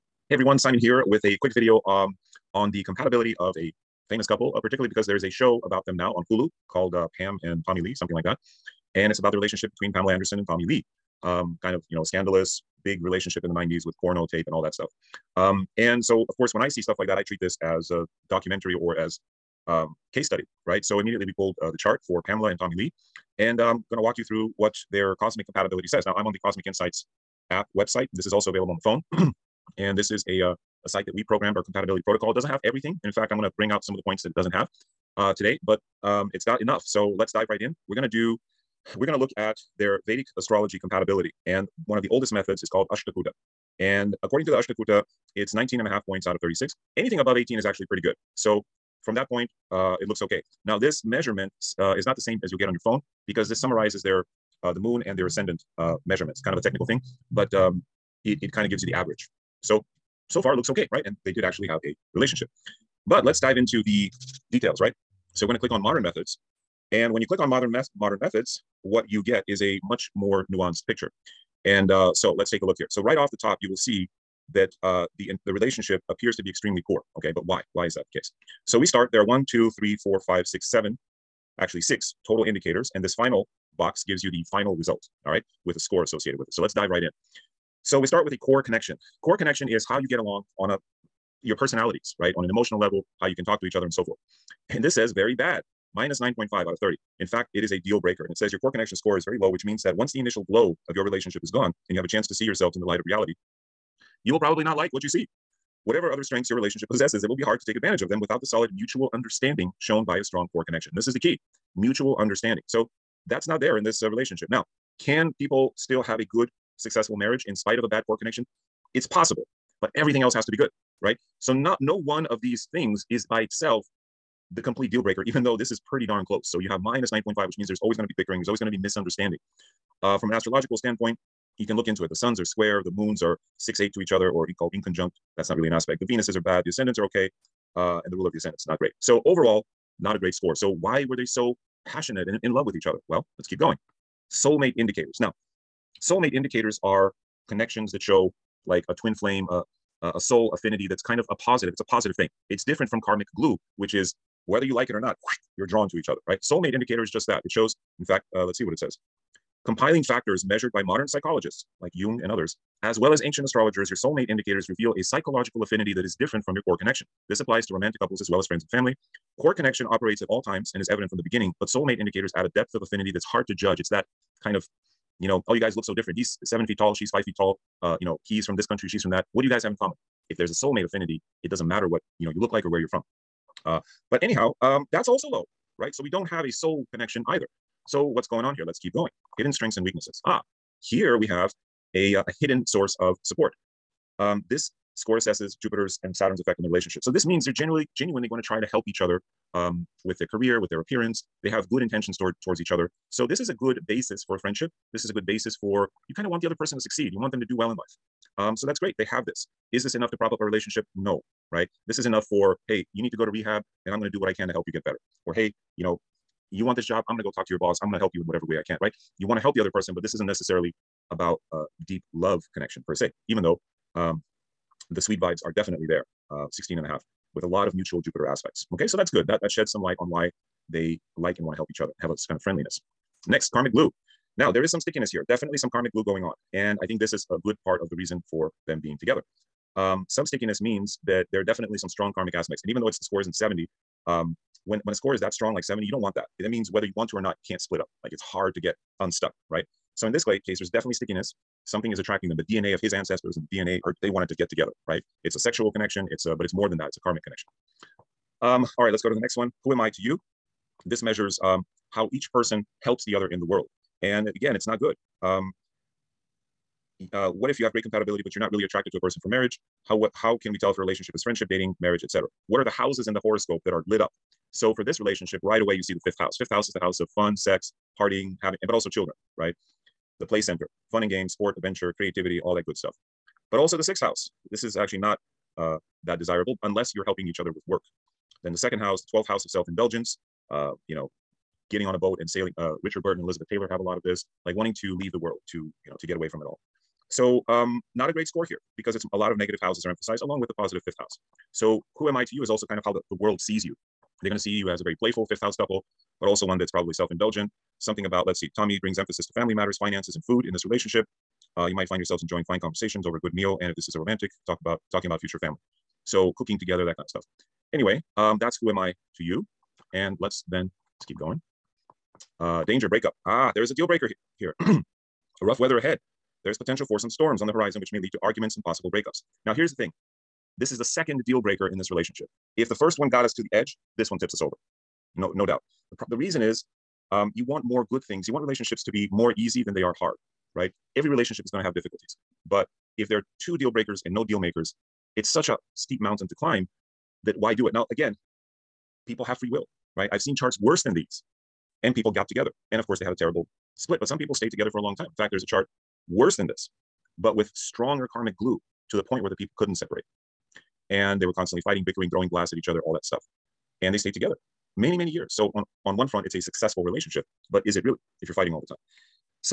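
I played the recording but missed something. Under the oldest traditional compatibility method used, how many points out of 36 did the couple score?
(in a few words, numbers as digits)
19.5.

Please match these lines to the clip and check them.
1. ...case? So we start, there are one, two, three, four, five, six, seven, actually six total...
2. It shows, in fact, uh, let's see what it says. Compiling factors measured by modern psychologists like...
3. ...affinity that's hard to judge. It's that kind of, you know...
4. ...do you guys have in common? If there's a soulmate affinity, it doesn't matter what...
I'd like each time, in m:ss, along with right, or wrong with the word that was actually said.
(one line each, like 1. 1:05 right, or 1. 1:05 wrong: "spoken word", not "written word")
1. 1:18 right
2. 2:37 right
3. 2:52 right
4. 2:59 right.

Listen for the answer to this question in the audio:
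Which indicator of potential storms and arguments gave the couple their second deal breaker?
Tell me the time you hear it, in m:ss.
5:22.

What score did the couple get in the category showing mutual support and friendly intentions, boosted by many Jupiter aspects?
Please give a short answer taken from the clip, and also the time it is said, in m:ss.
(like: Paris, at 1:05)
16.5, at 3:46.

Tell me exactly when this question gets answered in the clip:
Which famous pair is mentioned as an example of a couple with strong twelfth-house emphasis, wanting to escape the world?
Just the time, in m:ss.
4:52.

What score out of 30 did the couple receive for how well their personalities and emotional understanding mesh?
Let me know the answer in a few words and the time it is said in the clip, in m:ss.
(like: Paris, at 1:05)
-9.5, at 1:35.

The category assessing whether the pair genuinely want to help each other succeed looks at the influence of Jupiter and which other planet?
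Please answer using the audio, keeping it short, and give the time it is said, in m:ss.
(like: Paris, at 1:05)
Saturn, at 3:16.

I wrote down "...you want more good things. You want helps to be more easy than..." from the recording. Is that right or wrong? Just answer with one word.
wrong.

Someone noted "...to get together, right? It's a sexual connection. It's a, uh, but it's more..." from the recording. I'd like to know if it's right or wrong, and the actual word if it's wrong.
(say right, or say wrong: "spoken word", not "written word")
right.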